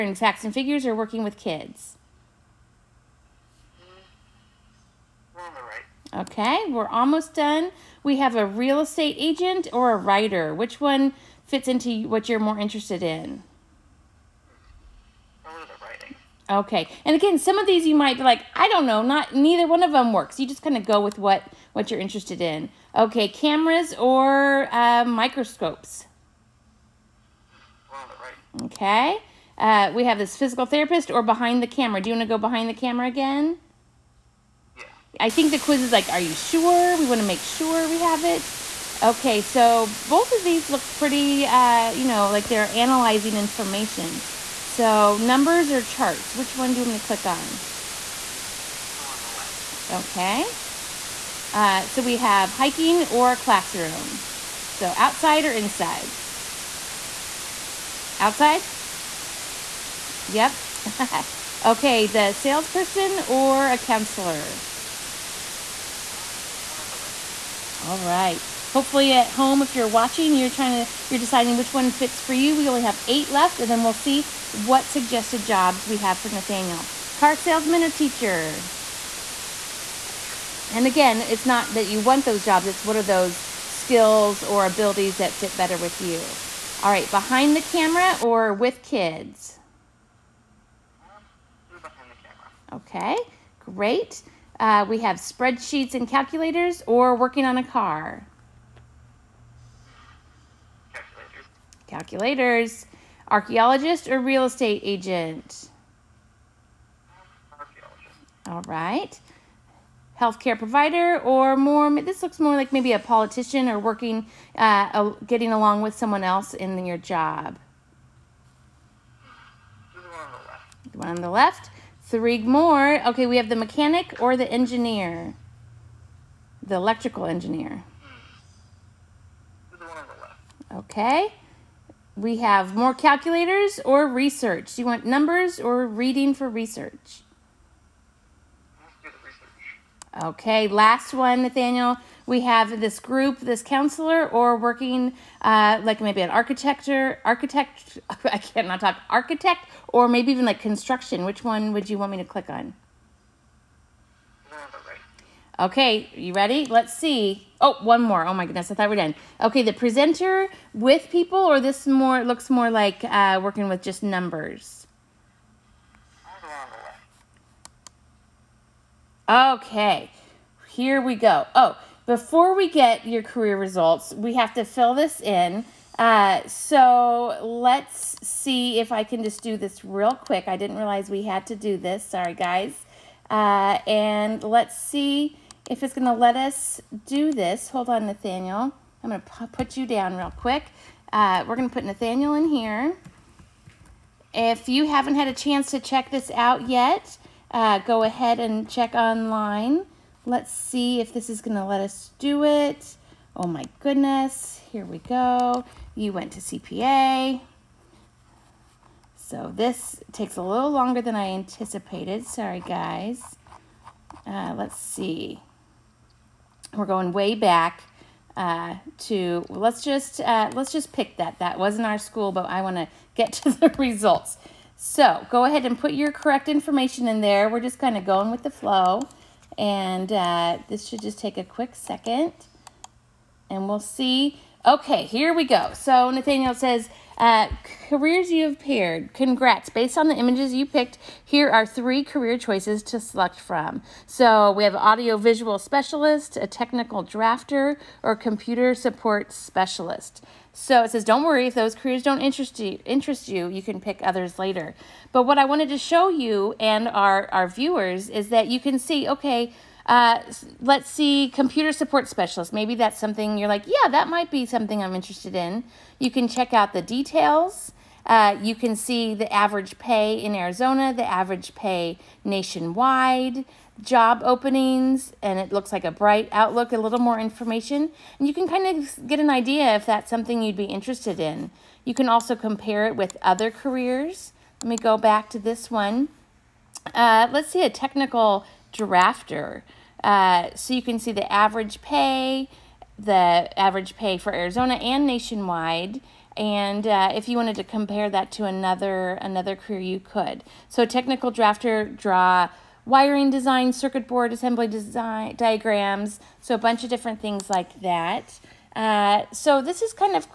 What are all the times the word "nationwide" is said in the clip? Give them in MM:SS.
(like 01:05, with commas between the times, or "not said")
04:32, 04:55.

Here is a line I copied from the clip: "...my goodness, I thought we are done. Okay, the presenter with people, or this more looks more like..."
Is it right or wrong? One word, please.
right.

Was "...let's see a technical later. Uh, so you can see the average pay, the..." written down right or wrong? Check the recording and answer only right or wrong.
wrong.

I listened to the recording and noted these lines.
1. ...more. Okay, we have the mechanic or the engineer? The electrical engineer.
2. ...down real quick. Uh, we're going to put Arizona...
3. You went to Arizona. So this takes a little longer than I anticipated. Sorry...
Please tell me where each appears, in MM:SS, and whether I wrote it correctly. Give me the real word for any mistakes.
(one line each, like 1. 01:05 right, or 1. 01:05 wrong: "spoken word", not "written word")
1. 02:02 right
2. 03:09 wrong: "Nathaniel", not "Arizona"
3. 03:25 wrong: "CPA", not "Arizona".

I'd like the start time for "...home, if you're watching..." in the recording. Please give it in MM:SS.
01:09.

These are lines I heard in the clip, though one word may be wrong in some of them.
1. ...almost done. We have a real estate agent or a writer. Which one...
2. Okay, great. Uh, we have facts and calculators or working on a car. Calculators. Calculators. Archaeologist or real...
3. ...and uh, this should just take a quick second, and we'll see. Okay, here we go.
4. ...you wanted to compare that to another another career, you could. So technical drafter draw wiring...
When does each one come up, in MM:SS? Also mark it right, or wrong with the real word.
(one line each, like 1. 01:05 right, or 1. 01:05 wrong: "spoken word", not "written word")
1. 00:06 right
2. 01:33 wrong: "spreadsheets", not "facts"
3. 03:49 right
4. 04:57 right.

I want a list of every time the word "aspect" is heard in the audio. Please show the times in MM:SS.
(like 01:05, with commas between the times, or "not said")
not said.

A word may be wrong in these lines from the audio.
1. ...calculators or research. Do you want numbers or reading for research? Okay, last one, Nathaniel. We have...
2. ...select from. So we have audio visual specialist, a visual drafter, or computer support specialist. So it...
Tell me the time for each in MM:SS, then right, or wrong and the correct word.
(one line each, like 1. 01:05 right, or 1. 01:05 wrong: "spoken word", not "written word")
1. 02:12 right
2. 04:02 wrong: "technical", not "visual".